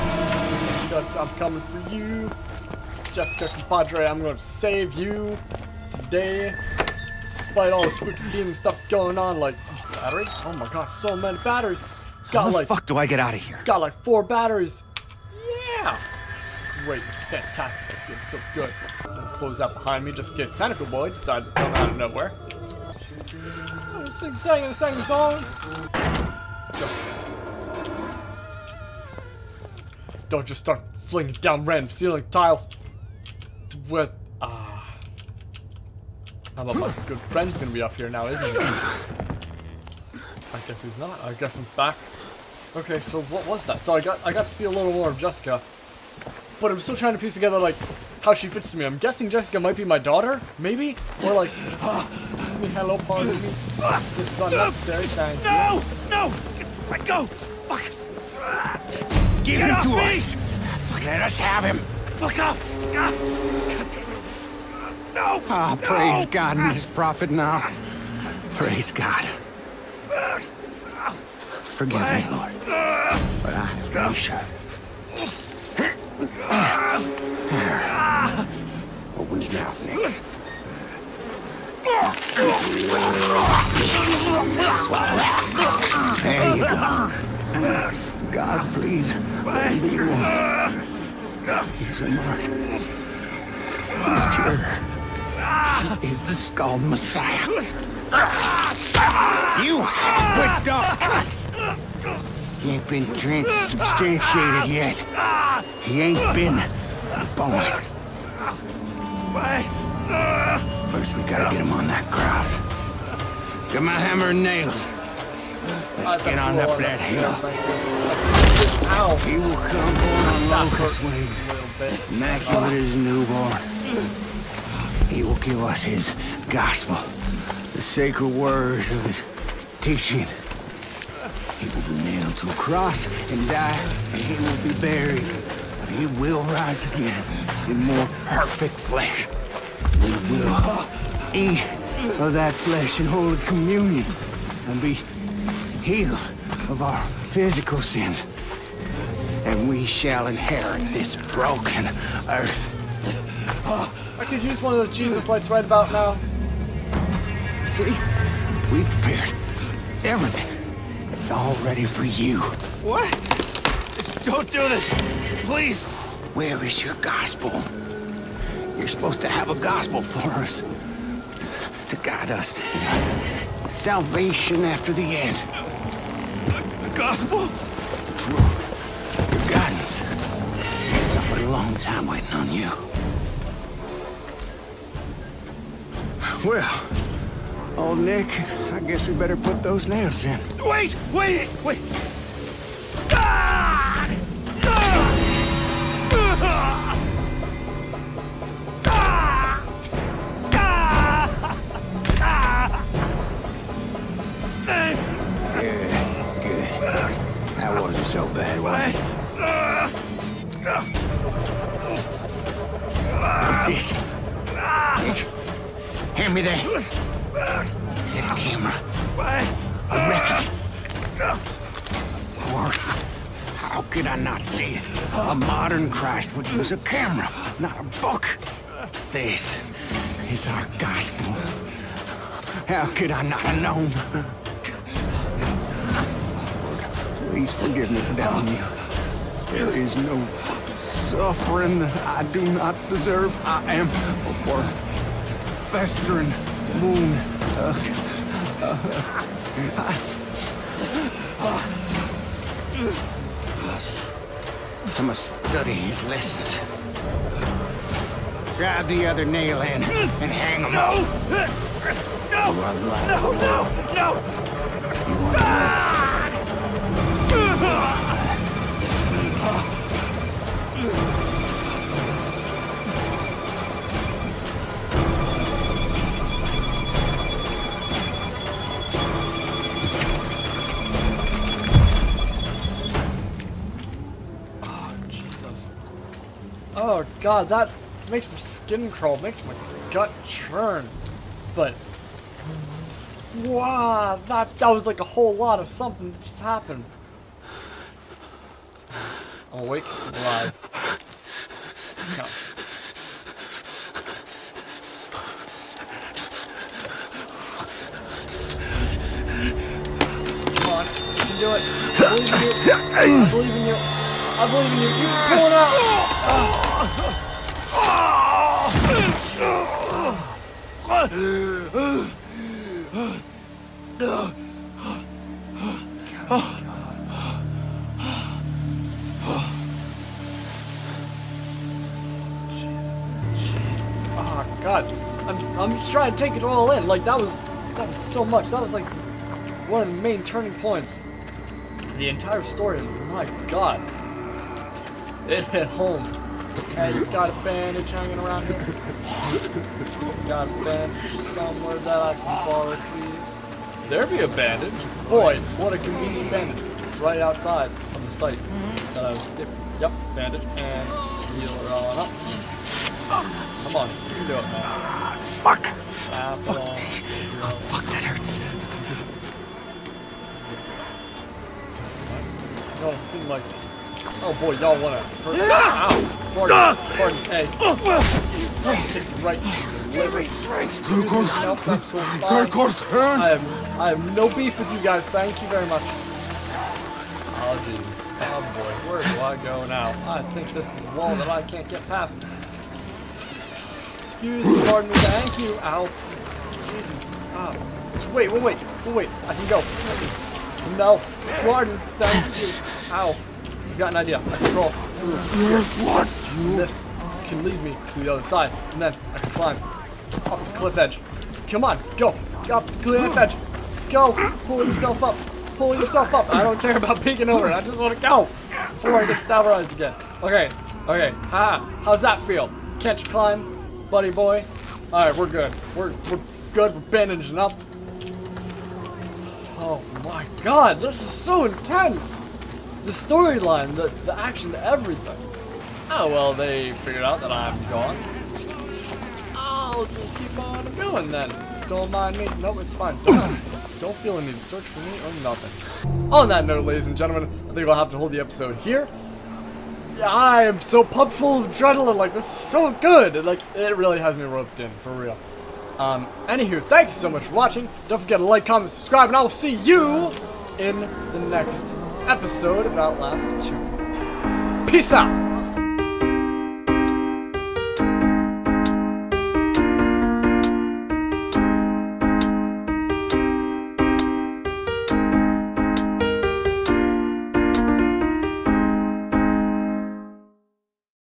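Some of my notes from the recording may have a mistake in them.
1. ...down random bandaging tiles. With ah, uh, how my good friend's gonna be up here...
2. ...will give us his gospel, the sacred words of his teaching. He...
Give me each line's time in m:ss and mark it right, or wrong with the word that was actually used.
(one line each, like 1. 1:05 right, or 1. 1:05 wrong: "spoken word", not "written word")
1. 0:31 wrong: "ceiling", not "bandaging"
2. 2:05 right.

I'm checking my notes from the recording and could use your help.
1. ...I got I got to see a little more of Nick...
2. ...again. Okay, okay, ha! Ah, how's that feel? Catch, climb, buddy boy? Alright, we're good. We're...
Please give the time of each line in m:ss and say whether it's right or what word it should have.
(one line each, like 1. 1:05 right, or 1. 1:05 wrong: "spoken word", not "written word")
1. 0:43 wrong: "Jessica", not "Nick"
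2. 6:59 right.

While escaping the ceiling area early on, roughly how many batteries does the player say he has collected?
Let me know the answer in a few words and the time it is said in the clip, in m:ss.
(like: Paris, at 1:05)
4, at 0:14.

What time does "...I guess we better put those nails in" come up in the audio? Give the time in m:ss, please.
3:08.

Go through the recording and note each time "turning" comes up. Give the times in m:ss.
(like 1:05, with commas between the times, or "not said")
5:40.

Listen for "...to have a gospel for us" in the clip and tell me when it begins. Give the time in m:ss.
2:49.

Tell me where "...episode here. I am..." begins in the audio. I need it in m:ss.
7:28.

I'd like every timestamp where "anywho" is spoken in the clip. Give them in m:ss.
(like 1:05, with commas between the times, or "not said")
7:36.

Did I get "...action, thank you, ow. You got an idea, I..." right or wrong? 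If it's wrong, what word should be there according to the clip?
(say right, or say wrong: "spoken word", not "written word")
wrong: "pardon", not "action".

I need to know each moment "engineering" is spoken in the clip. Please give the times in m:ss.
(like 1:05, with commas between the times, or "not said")
not said.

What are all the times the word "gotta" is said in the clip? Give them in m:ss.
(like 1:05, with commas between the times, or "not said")
1:51.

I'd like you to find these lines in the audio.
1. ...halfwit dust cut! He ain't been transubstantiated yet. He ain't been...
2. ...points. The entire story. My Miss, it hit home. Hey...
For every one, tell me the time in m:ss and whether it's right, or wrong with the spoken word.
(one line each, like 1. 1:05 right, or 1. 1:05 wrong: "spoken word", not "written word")
1. 1:39 right
2. 5:40 wrong: "God", not "Miss".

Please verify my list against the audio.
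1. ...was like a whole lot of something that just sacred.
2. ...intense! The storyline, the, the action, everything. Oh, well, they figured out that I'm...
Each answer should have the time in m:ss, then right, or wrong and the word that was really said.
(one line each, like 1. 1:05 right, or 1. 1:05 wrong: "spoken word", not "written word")
1. 4:54 wrong: "happened", not "sacred"
2. 7:11 right.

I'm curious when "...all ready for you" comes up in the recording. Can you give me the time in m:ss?
2:41.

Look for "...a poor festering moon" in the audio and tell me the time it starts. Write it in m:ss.
4:03.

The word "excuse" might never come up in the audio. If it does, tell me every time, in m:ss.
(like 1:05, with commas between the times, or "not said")
0:51, 6:33.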